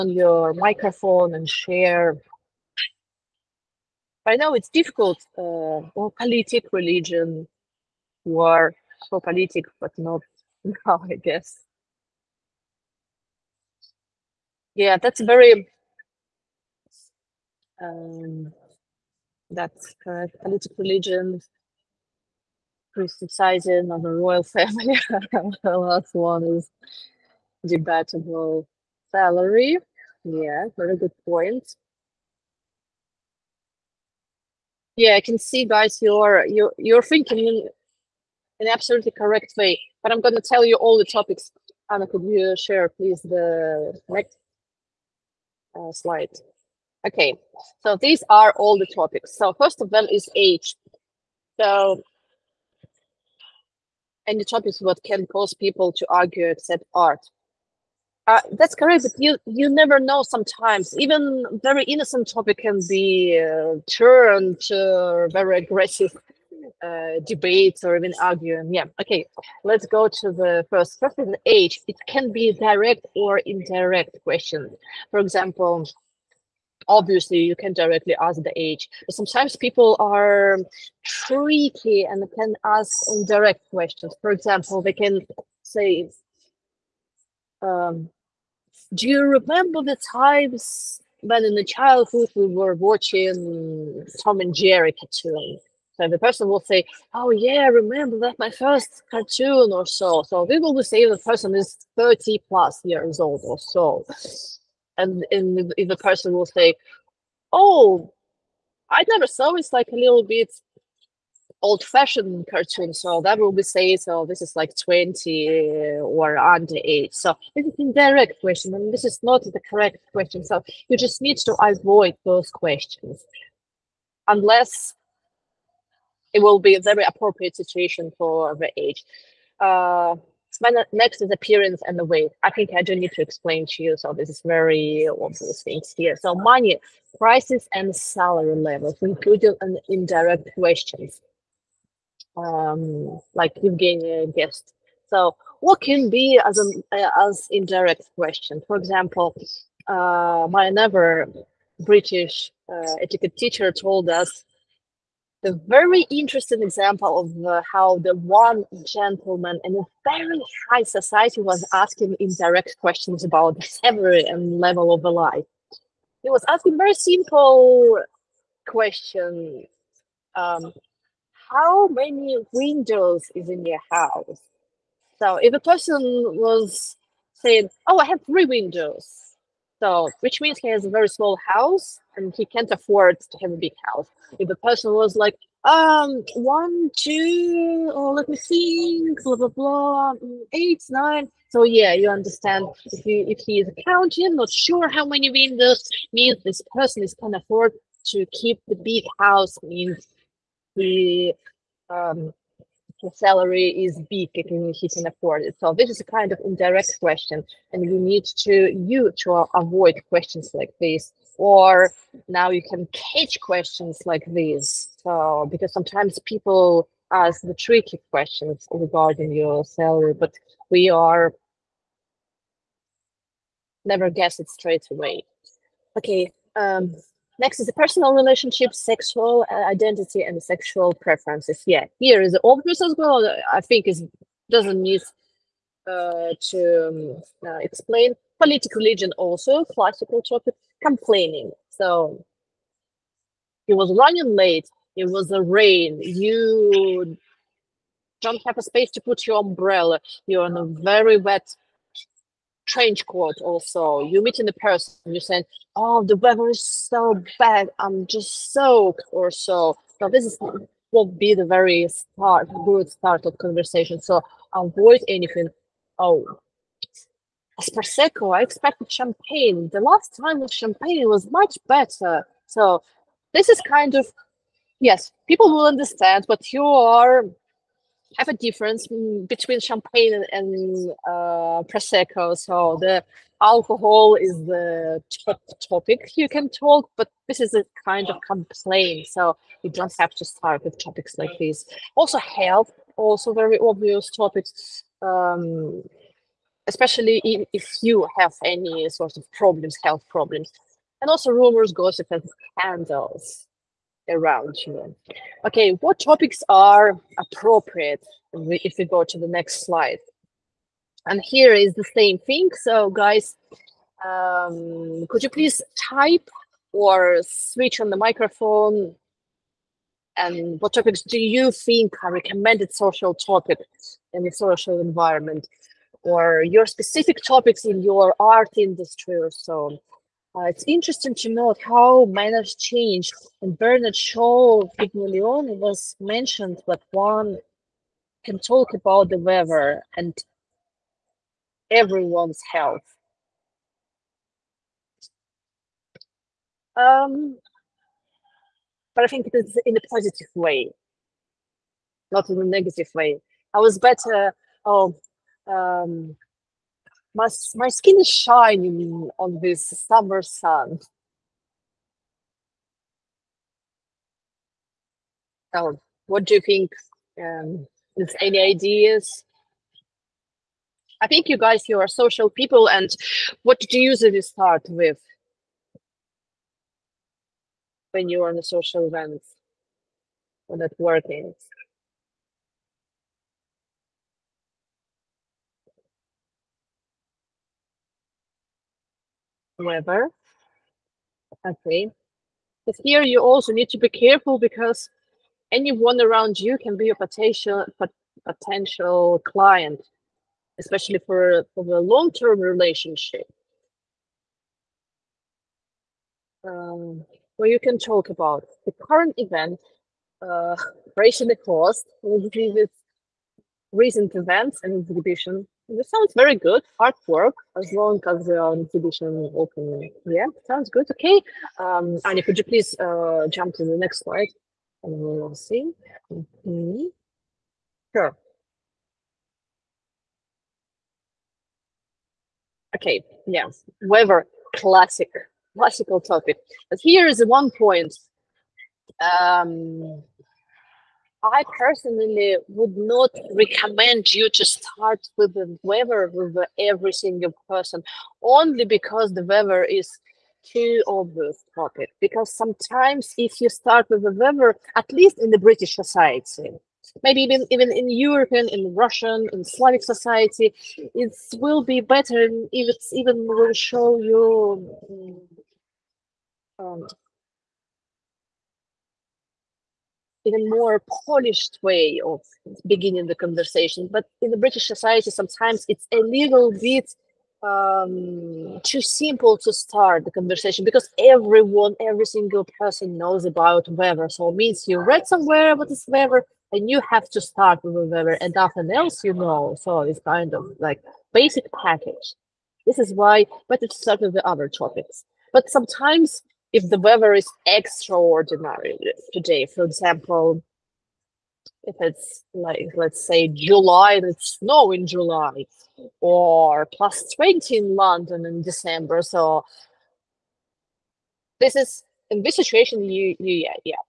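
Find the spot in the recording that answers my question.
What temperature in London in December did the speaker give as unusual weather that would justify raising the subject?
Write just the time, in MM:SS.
08:26.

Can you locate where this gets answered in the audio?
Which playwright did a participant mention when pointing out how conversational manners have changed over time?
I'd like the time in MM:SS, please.
05:33.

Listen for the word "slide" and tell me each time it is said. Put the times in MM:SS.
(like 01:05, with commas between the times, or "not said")
00:45, 05:09, 07:04.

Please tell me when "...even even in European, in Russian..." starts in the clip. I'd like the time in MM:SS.
07:37.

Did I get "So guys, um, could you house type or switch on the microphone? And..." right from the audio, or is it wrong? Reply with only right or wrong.
wrong.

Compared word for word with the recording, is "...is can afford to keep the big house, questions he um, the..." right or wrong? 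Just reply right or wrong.
wrong.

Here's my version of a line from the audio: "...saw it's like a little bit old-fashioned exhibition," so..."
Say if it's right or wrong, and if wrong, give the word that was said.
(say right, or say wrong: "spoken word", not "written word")
wrong: "cartoon", not "exhibition".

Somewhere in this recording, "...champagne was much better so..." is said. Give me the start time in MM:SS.
04:30.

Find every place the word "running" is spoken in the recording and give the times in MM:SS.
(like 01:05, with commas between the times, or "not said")
04:03.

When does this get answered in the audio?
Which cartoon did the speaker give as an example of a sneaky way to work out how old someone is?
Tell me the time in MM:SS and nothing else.
01:34.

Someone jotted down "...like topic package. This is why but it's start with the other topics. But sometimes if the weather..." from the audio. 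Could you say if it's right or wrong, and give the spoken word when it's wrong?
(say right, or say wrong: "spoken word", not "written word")
wrong: "basic", not "topic".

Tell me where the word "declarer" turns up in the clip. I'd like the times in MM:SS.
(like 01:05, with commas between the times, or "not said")
not said.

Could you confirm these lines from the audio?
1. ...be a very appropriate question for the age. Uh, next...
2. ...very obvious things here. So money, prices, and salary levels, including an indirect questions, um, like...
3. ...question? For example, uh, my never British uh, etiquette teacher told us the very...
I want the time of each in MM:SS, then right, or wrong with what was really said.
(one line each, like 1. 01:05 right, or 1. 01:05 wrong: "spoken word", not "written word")
1. 02:06 wrong: "situation", not "question"
2. 02:14 right
3. 02:28 right.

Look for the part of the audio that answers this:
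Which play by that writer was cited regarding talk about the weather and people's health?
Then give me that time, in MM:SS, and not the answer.
05:34.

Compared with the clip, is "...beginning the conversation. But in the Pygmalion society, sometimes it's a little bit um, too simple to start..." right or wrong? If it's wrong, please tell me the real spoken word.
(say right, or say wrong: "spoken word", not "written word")
wrong: "British", not "Pygmalion".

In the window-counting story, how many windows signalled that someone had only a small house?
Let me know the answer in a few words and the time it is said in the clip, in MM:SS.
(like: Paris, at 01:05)
3, at 02:58.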